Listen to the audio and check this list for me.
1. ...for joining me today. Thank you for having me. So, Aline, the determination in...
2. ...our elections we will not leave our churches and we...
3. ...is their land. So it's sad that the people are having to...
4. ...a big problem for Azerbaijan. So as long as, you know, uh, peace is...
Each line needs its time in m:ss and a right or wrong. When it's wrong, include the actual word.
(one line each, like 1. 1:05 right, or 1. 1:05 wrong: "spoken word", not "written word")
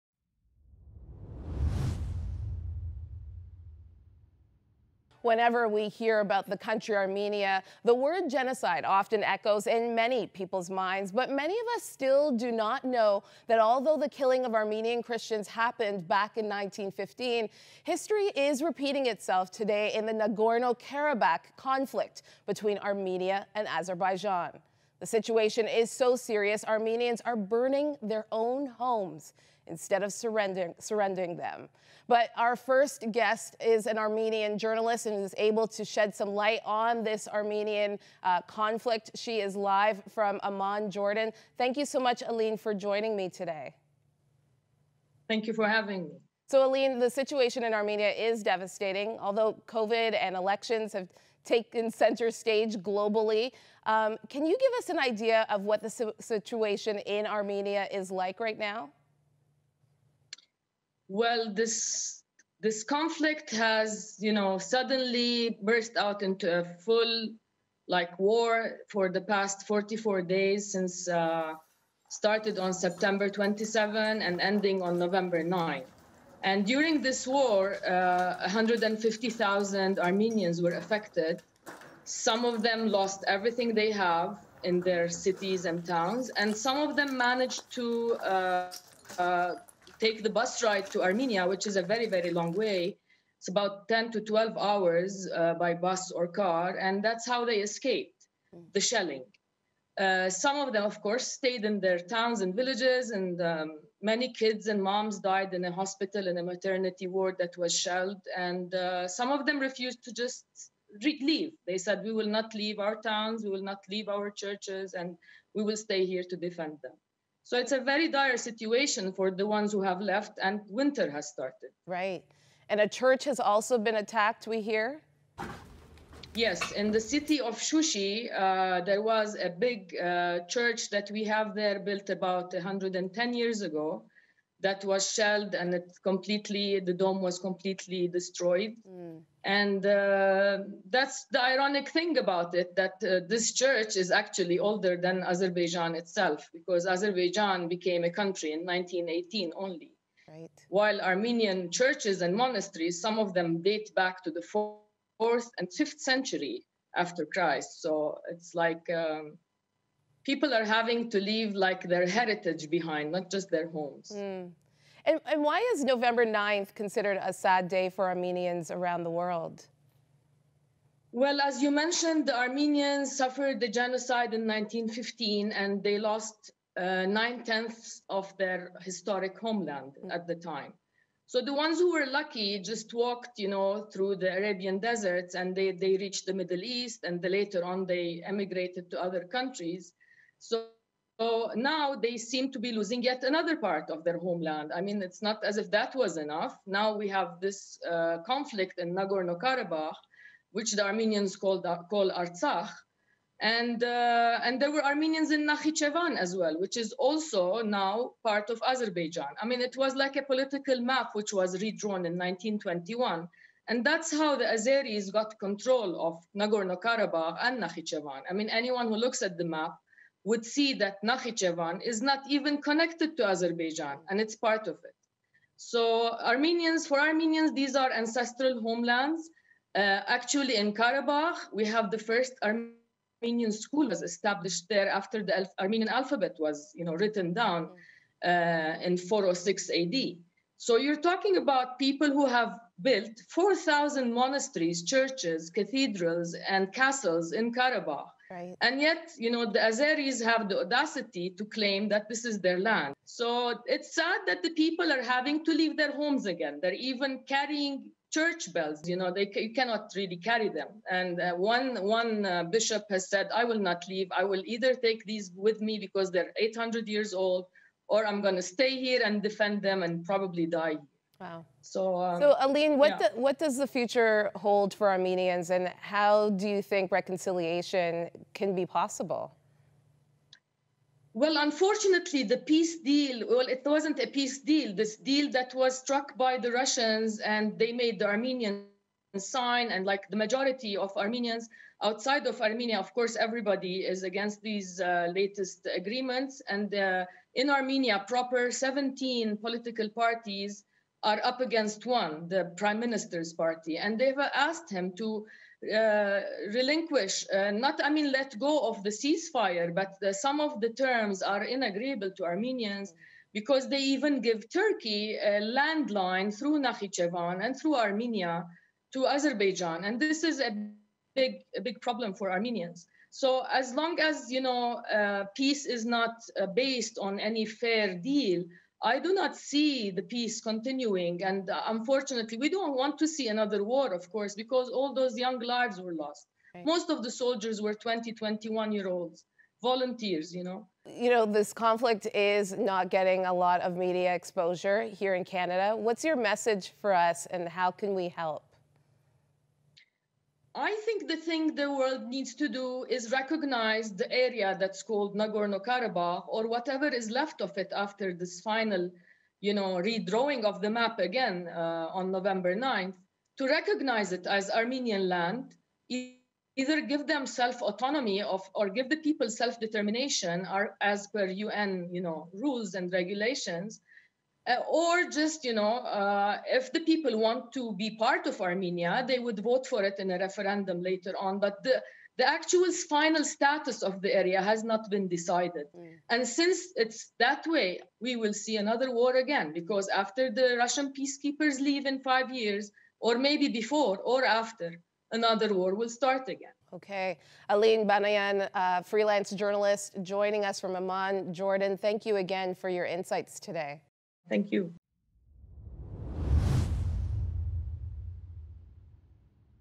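1. 0:42 wrong: "situation", not "determination"
2. 1:52 wrong: "towns", not "elections"
3. 4:12 right
4. 5:21 wrong: "Armenians", not "Azerbaijan".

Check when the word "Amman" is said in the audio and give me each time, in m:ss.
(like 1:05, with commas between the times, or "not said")
0:40, 6:40.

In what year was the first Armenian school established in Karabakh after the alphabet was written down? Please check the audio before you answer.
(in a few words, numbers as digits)
406 AD.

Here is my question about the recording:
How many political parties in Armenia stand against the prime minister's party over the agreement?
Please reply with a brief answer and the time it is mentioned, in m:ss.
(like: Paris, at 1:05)
17, at 4:58.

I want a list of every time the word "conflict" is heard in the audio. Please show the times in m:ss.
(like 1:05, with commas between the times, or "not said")
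0:21, 0:38, 1:02, 3:18, 5:41.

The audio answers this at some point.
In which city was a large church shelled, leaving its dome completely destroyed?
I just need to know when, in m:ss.
2:07.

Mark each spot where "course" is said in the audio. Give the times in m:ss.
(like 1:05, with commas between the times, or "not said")
1:41, 4:52, 5:34.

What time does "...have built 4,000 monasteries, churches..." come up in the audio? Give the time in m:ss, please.
4:02.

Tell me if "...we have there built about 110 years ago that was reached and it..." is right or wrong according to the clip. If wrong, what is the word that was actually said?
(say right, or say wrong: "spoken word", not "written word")
wrong: "shelled", not "reached".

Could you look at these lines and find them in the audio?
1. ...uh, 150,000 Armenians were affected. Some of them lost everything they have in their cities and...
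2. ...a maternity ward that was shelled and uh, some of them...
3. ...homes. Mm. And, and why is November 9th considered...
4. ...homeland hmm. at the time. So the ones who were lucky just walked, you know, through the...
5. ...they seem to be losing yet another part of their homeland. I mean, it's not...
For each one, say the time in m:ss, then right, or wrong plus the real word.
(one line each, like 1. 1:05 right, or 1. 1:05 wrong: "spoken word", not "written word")
1. 1:17 right
2. 1:46 right
3. 2:43 right
4. 2:59 right
5. 3:11 right.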